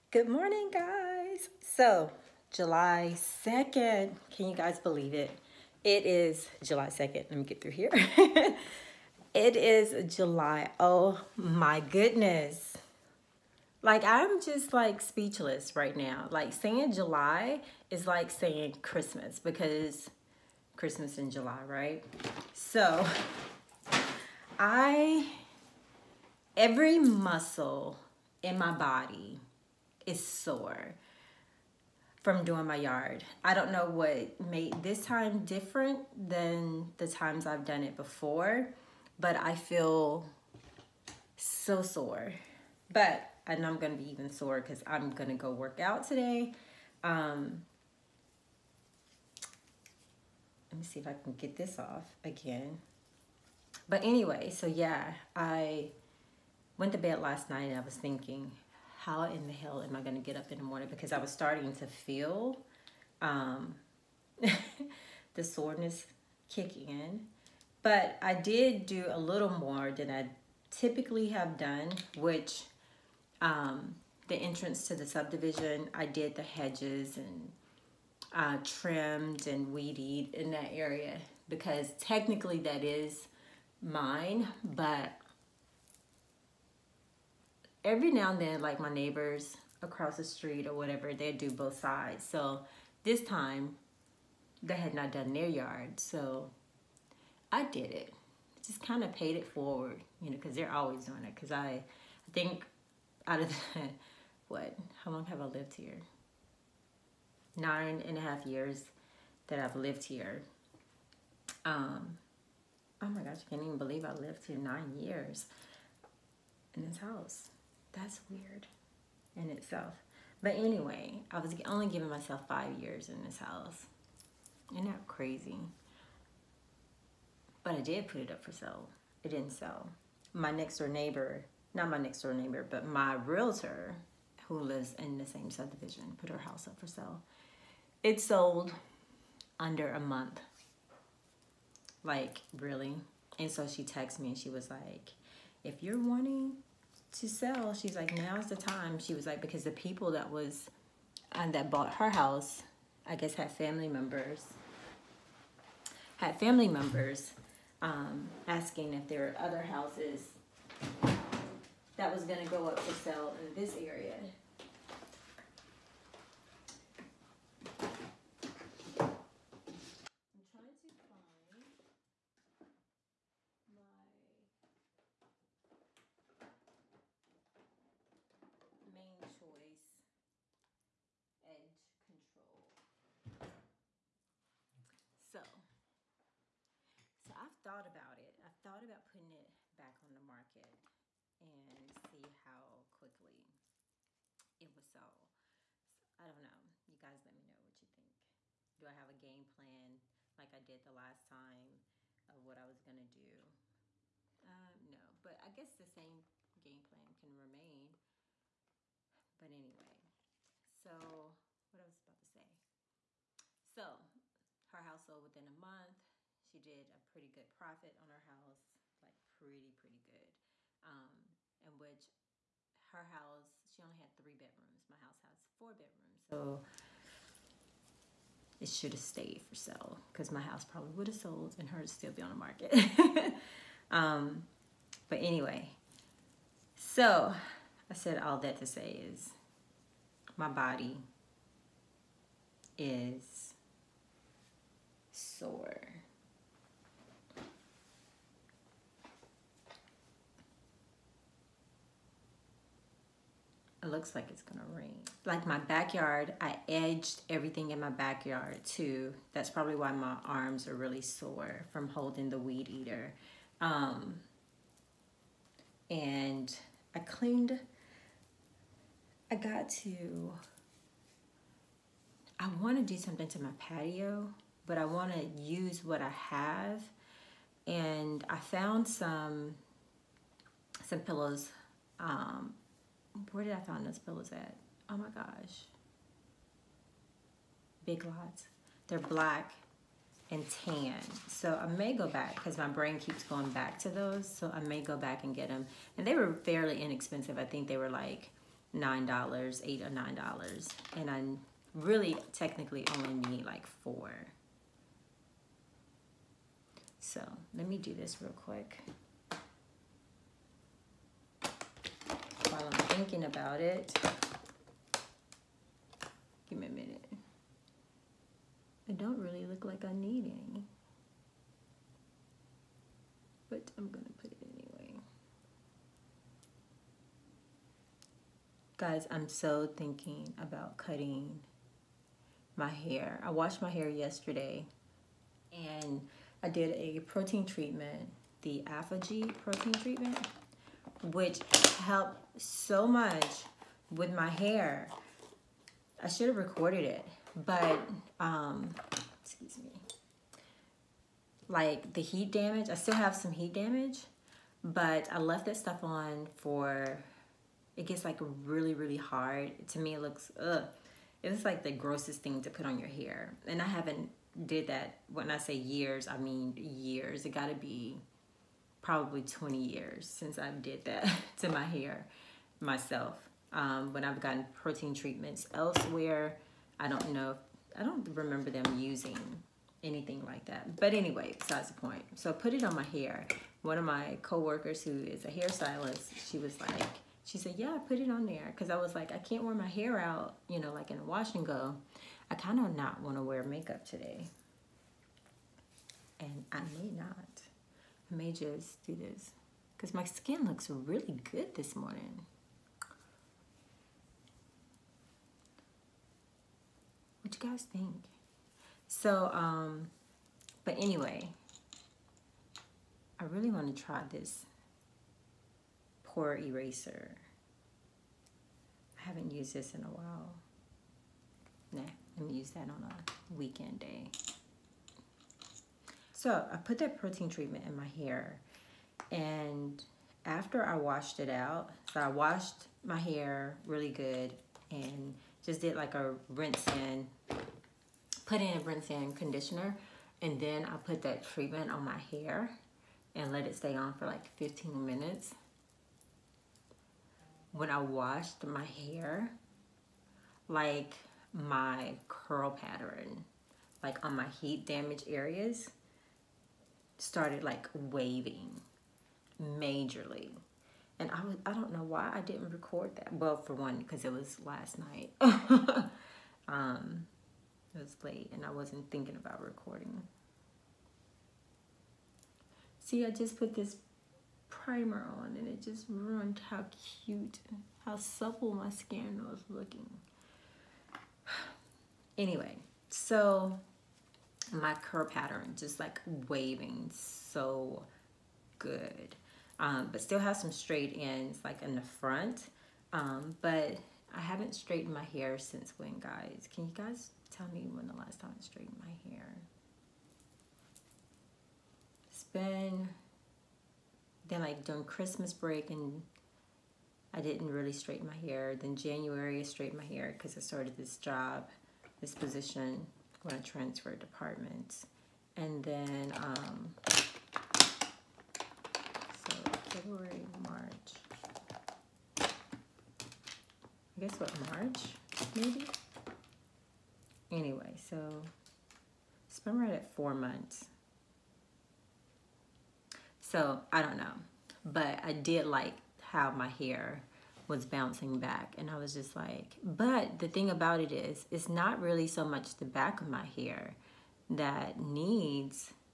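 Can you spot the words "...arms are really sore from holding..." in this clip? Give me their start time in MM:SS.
04:20.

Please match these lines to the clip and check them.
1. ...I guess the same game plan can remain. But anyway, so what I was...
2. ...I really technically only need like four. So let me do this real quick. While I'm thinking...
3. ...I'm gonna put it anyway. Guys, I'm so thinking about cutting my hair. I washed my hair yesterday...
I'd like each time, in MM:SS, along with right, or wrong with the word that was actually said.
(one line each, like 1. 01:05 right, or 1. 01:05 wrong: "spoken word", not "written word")
1. 03:25 right
2. 05:01 right
3. 05:23 right.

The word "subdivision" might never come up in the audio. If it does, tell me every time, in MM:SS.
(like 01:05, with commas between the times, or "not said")
01:15, 02:15.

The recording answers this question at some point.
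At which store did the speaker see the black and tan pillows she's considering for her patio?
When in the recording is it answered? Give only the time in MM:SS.
04:47.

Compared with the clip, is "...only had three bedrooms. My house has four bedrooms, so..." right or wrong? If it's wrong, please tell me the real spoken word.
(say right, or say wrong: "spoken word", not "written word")
right.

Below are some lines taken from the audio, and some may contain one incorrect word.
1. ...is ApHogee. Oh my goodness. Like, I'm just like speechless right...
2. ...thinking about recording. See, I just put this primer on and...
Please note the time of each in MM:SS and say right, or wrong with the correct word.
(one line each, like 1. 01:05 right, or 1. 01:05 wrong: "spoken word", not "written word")
1. 00:09 wrong: "July", not "ApHogee"
2. 07:48 right.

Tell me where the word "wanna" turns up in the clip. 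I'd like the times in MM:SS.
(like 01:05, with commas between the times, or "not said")
04:32.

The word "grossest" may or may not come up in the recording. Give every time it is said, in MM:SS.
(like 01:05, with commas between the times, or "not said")
06:01.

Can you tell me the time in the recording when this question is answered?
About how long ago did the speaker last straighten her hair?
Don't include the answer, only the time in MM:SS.
08:49.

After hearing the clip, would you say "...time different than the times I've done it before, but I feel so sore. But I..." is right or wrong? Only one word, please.
right.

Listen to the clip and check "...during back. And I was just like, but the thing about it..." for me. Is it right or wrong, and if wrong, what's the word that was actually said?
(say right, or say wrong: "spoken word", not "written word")
wrong: "bouncing", not "during".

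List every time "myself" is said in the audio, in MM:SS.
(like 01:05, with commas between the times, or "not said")
02:02, 06:12.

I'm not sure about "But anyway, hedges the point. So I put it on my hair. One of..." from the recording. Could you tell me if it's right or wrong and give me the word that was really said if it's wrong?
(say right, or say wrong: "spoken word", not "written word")
wrong: "besides", not "hedges".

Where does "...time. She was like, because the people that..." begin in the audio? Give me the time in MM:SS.
02:28.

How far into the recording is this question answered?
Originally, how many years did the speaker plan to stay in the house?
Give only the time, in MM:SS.
02:02.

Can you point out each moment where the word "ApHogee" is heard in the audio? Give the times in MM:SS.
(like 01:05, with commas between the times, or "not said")
05:38.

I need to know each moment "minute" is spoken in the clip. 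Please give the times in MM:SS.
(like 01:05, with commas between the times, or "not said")
05:16, 07:24.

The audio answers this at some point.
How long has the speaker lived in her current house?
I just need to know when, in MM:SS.
01:47.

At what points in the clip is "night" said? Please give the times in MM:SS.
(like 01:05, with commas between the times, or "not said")
00:57, 07:44.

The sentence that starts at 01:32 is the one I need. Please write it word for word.
So this time, they had not done their yard.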